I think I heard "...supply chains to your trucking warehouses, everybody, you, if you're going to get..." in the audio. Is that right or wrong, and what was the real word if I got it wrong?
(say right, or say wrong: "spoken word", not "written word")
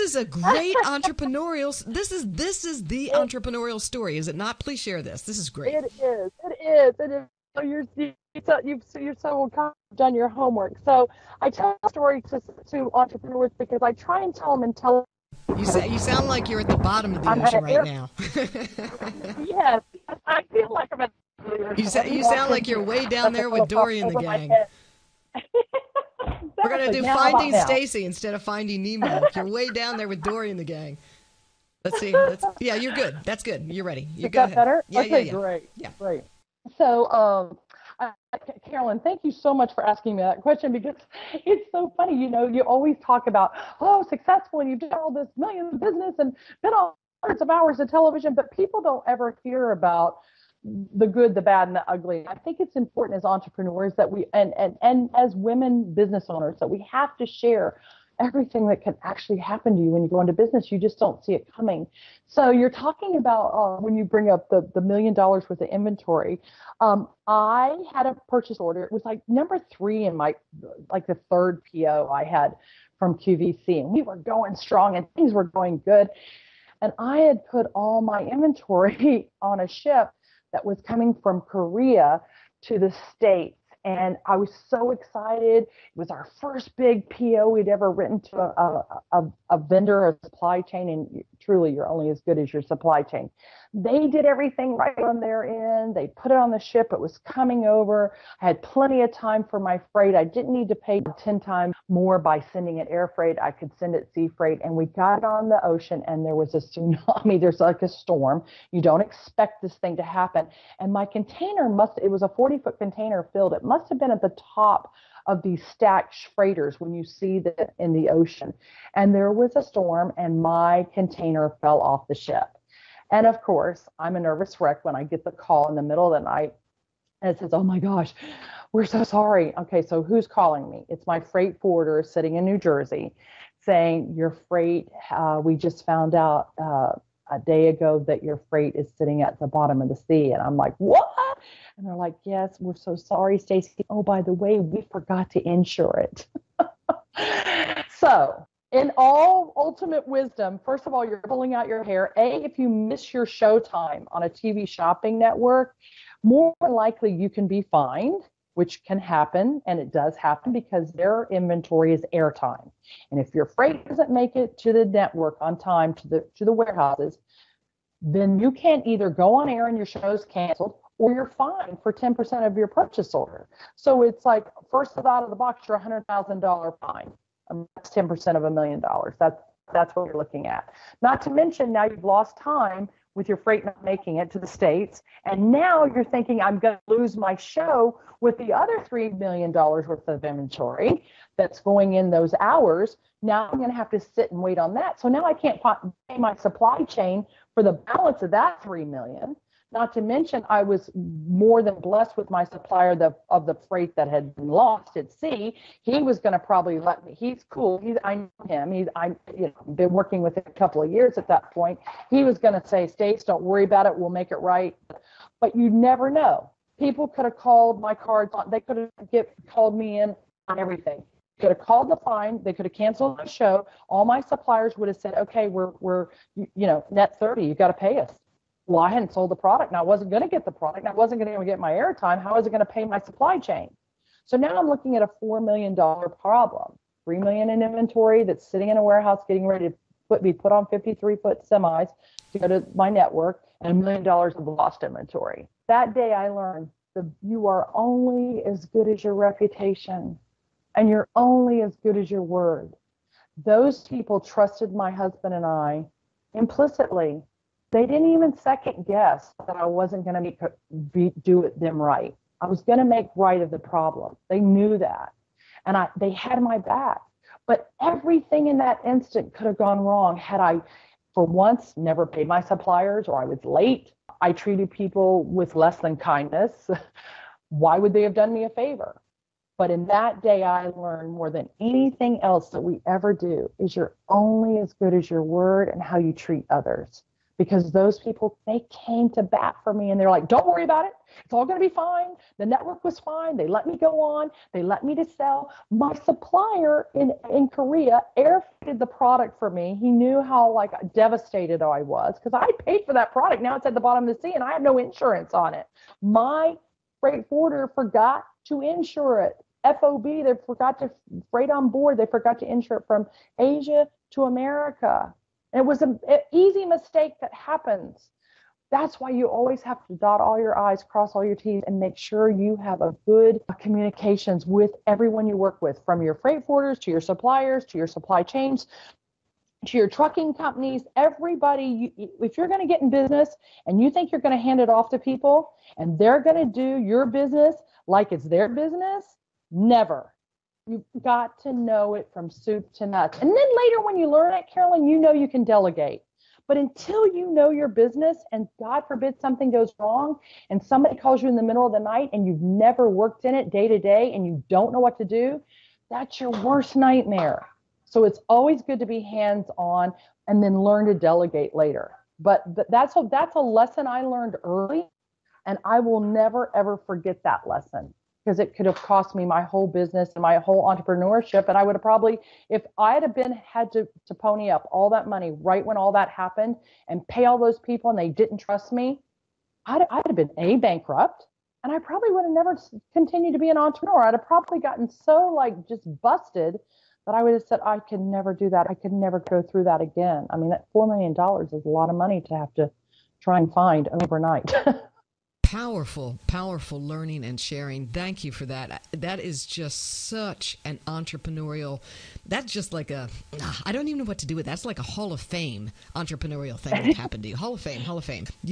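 wrong: "companies", not "warehouses".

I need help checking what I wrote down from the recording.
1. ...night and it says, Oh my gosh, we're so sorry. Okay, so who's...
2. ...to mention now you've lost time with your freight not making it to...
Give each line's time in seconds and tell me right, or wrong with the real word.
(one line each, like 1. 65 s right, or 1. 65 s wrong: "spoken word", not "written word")
1. 126 s right
2. 181 s right.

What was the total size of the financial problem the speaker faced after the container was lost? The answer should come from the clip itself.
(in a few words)
$4 million.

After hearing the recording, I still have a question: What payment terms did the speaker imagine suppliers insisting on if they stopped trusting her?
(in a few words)
Net 30.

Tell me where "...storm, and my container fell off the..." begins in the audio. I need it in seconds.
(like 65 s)
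119 s.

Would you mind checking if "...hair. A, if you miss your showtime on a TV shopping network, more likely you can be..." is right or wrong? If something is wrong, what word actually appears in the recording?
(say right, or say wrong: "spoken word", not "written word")
right.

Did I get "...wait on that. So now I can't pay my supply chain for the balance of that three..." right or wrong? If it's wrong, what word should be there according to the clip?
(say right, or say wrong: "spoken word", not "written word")
right.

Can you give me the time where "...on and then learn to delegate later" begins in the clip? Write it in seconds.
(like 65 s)
359 s.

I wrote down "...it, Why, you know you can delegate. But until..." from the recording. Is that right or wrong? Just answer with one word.
wrong.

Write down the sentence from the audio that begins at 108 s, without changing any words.
You don't expect this thing to happen.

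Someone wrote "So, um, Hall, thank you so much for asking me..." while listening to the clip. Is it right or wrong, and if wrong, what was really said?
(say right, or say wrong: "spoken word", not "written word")
wrong: "Carolyn", not "Hall".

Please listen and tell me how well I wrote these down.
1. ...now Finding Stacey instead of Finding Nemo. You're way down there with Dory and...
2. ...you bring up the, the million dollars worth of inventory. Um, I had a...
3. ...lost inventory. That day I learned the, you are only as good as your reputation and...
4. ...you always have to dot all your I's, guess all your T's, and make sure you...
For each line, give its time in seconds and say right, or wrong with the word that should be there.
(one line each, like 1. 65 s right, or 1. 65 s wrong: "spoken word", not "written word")
1. 27 s right
2. 63 s right
3. 244 s right
4. 319 s wrong: "cross", not "guess".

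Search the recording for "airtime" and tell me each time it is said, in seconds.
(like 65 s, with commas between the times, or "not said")
162 s, 231 s.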